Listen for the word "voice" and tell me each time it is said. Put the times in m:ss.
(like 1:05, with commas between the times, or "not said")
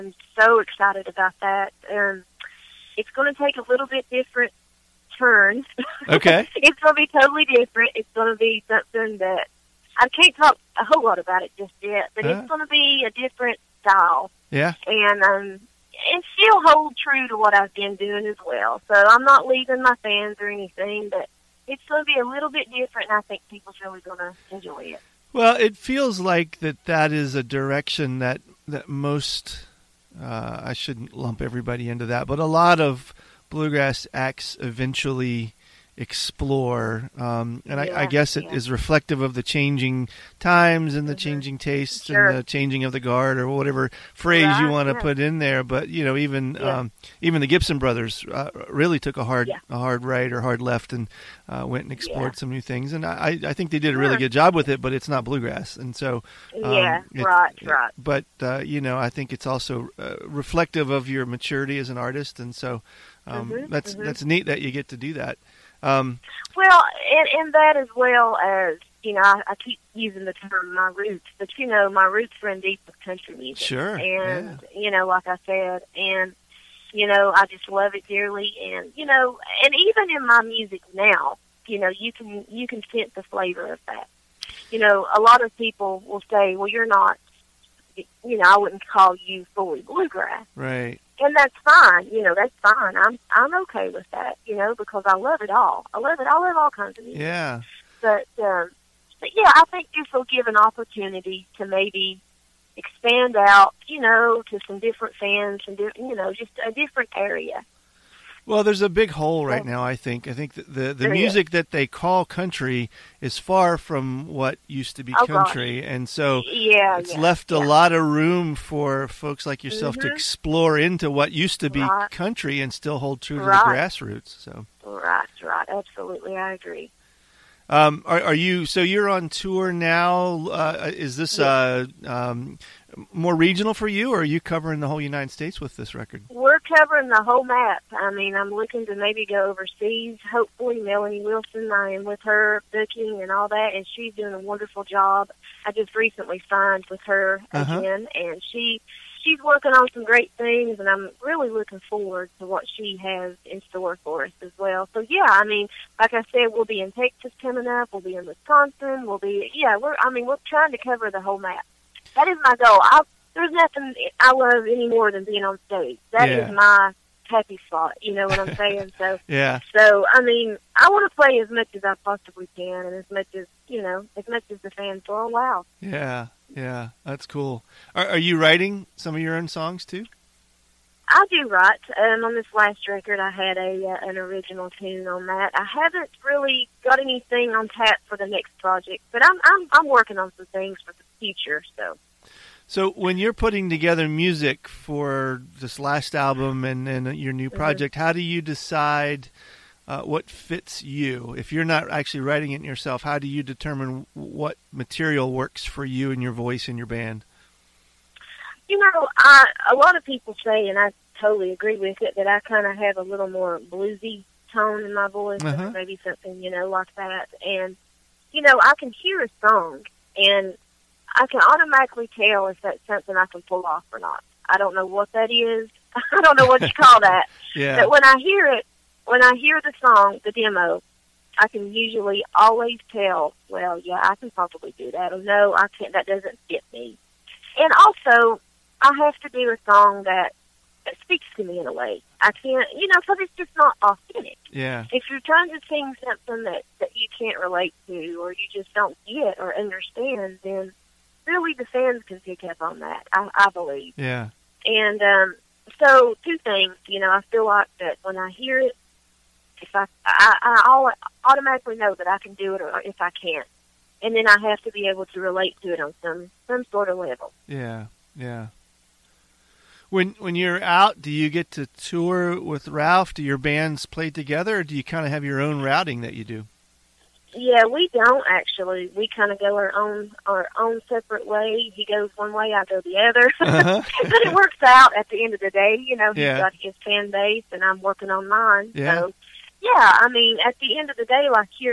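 3:26, 3:35.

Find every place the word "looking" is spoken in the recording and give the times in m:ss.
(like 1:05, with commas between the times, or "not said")
2:18, 2:31.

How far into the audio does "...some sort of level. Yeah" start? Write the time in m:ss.
4:26.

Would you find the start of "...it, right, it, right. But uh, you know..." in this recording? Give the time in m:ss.
0:57.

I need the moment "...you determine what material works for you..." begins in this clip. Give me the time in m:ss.
3:23.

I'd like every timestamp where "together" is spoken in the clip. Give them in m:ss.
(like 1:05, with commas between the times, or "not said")
3:13, 4:34.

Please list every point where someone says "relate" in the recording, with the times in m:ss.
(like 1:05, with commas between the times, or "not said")
4:07, 4:25.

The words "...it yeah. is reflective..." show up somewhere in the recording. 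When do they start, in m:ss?
0:38.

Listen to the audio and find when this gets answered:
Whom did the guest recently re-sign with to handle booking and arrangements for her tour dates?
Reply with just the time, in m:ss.
2:20.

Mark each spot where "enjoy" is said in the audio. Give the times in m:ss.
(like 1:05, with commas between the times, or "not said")
0:24.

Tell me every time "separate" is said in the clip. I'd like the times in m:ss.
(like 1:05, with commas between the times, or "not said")
4:40.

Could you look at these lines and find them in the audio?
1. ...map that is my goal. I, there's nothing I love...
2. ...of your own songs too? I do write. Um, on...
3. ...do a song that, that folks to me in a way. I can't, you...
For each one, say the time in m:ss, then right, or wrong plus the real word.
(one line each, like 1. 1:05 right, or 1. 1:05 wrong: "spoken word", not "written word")
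1. 2:41 right
2. 2:59 right
3. 3:59 wrong: "speaks", not "folks".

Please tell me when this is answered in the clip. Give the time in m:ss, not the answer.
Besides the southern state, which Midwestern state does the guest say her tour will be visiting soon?
2:38.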